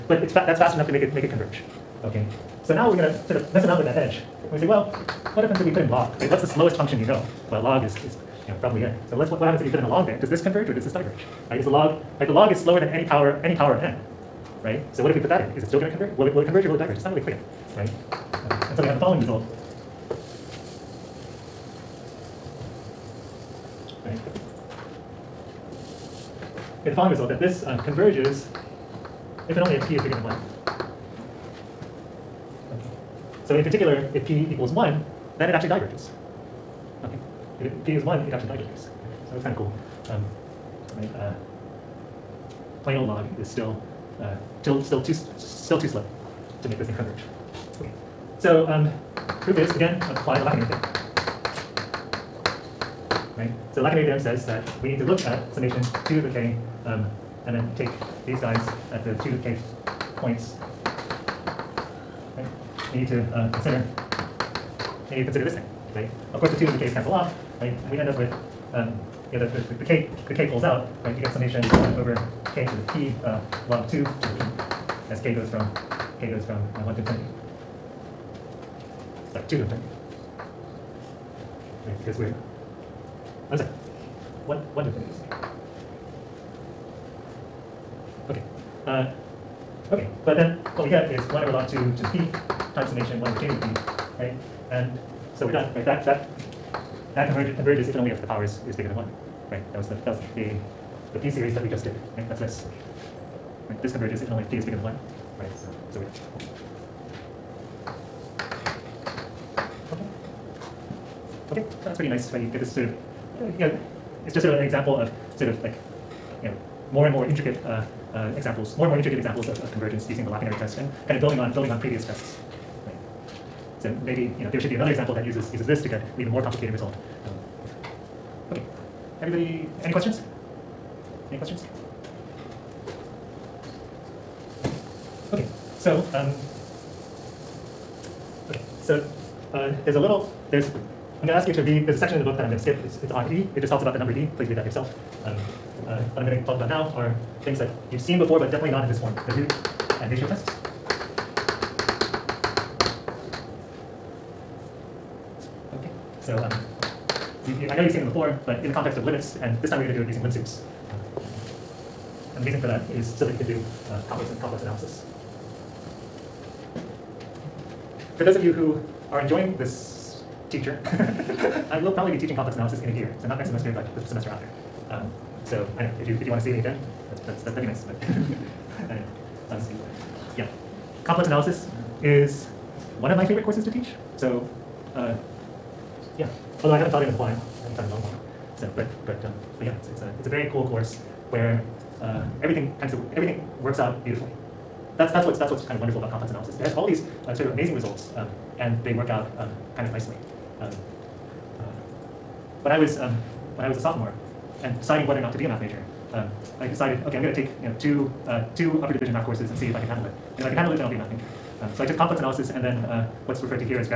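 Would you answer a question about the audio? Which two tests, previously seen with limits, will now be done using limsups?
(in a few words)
Root and ratio tests.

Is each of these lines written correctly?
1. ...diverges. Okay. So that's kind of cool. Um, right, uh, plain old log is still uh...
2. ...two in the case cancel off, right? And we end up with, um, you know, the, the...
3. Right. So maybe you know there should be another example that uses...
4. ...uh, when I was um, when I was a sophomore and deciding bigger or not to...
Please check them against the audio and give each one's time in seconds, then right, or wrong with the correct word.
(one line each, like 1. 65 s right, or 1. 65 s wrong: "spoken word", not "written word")
1. 38 s right
2. 66 s right
3. 122 s right
4. 201 s wrong: "whether", not "bigger".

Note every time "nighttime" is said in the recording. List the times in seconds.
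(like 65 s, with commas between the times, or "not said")
not said.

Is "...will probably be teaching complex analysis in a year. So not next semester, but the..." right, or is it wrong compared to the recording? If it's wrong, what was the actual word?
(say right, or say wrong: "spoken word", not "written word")
right.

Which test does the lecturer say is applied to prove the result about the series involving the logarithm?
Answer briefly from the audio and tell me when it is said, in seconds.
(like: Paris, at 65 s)
Lacunary test, at 50 s.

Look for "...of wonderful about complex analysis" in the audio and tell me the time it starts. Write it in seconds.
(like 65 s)
195 s.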